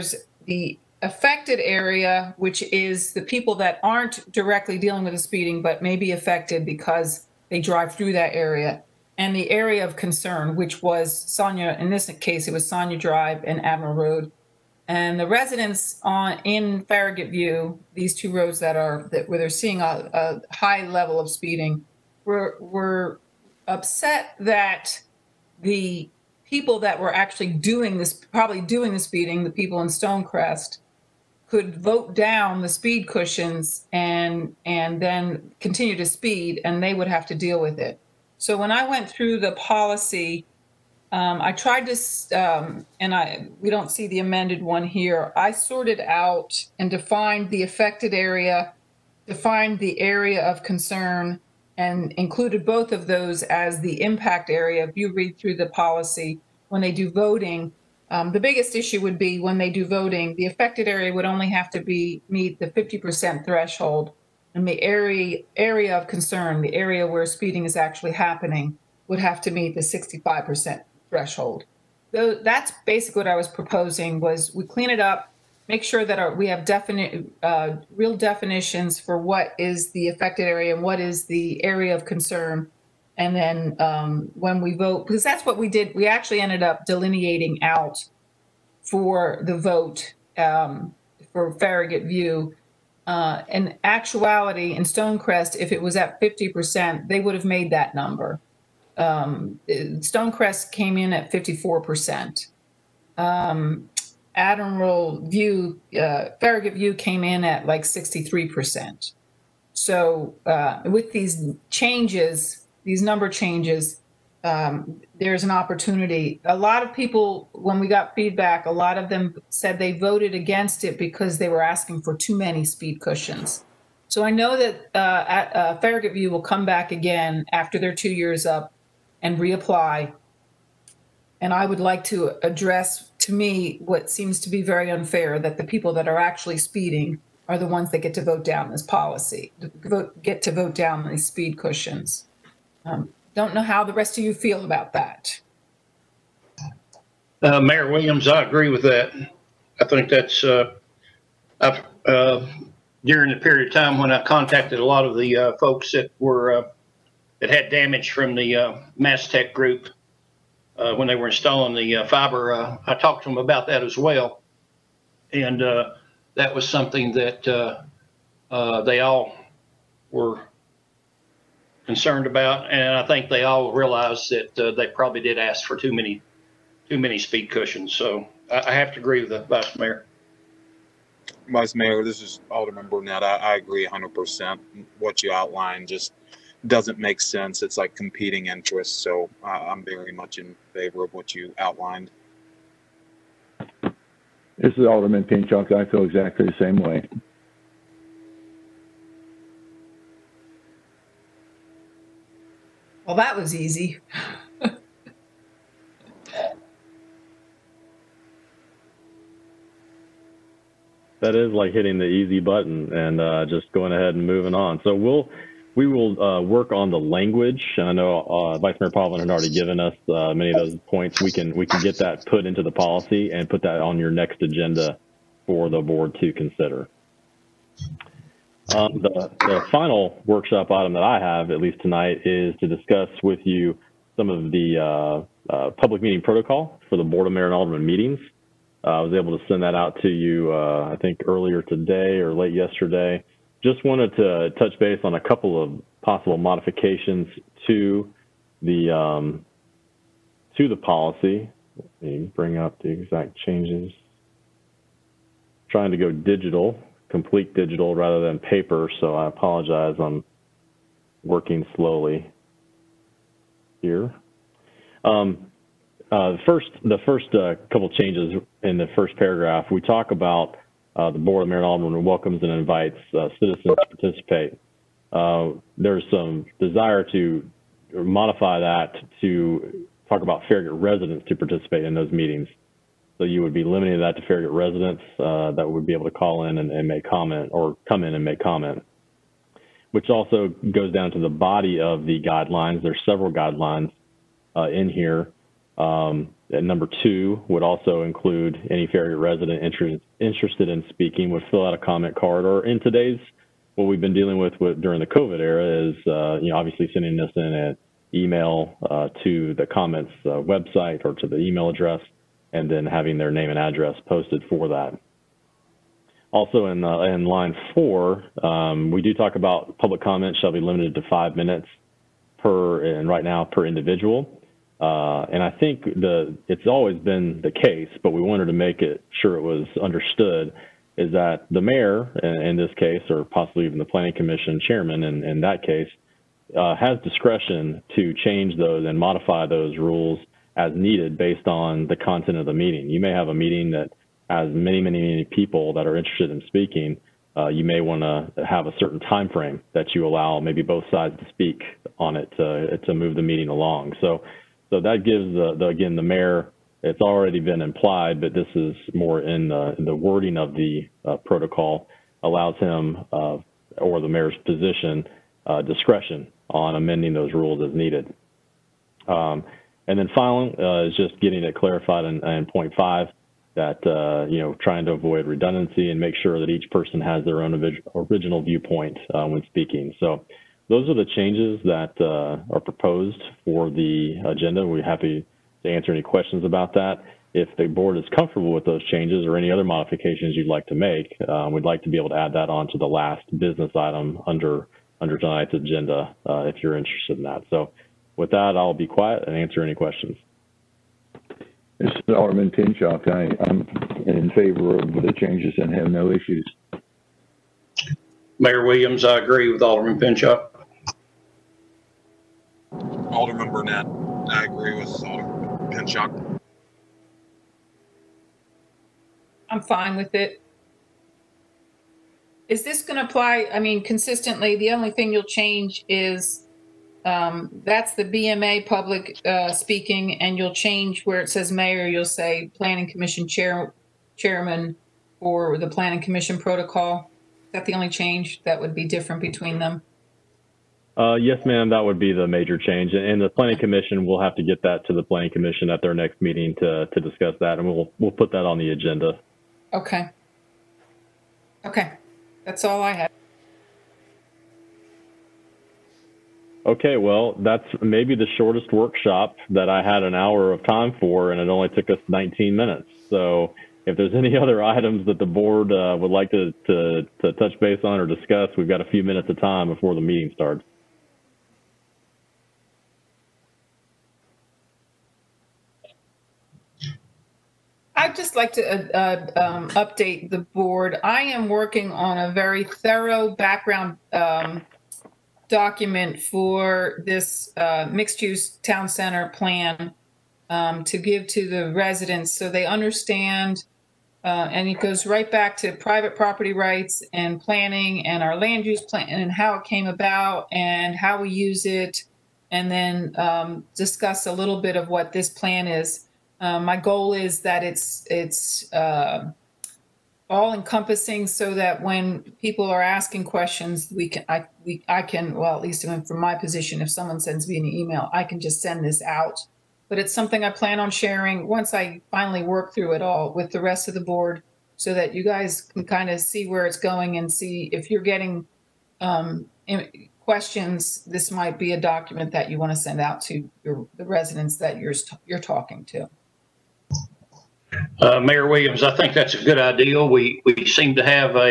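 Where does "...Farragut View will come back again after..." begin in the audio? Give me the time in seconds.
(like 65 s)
125 s.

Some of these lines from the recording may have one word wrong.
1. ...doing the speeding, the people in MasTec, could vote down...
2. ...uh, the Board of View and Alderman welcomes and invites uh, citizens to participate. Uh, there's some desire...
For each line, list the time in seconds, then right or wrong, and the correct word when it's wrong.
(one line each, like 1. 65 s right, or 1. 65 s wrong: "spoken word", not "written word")
1. 28 s wrong: "Stonecrest", not "MasTec"
2. 270 s wrong: "Mayor", not "View".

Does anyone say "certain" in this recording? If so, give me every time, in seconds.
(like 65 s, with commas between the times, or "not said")
348 s.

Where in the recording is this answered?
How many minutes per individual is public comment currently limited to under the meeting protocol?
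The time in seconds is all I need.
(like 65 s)
321 s.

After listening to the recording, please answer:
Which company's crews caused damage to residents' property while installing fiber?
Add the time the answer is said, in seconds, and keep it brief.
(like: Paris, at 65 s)
MasTec, at 158 s.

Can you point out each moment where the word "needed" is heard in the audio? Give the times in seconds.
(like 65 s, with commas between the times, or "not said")
340 s, 367 s.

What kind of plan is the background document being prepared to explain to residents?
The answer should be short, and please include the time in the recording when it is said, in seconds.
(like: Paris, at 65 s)
mixed use town center, at 487 s.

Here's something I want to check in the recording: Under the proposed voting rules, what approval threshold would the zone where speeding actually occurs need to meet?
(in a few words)
65%.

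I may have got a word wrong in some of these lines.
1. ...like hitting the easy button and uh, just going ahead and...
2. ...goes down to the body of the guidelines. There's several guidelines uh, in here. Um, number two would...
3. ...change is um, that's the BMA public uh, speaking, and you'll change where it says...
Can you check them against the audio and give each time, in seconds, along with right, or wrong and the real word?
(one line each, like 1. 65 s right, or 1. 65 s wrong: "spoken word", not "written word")
1. 211 s right
2. 290 s right
3. 425 s right.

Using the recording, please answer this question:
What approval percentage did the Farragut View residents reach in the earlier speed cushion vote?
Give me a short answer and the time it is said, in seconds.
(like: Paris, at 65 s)
63%, at 107 s.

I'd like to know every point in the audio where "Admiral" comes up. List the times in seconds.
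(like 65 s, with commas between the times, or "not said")
13 s, 104 s.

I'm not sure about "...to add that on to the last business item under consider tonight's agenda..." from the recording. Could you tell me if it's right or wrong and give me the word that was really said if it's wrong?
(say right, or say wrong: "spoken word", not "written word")
wrong: "under", not "consider".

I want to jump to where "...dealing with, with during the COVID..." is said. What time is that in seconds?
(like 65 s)
304 s.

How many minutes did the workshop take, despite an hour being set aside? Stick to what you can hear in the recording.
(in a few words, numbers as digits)
19.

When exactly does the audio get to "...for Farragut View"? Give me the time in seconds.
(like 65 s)
91 s.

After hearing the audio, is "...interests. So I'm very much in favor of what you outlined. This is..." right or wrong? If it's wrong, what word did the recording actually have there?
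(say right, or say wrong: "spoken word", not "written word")
right.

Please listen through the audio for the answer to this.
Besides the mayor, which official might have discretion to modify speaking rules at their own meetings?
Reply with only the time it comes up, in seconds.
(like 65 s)
333 s.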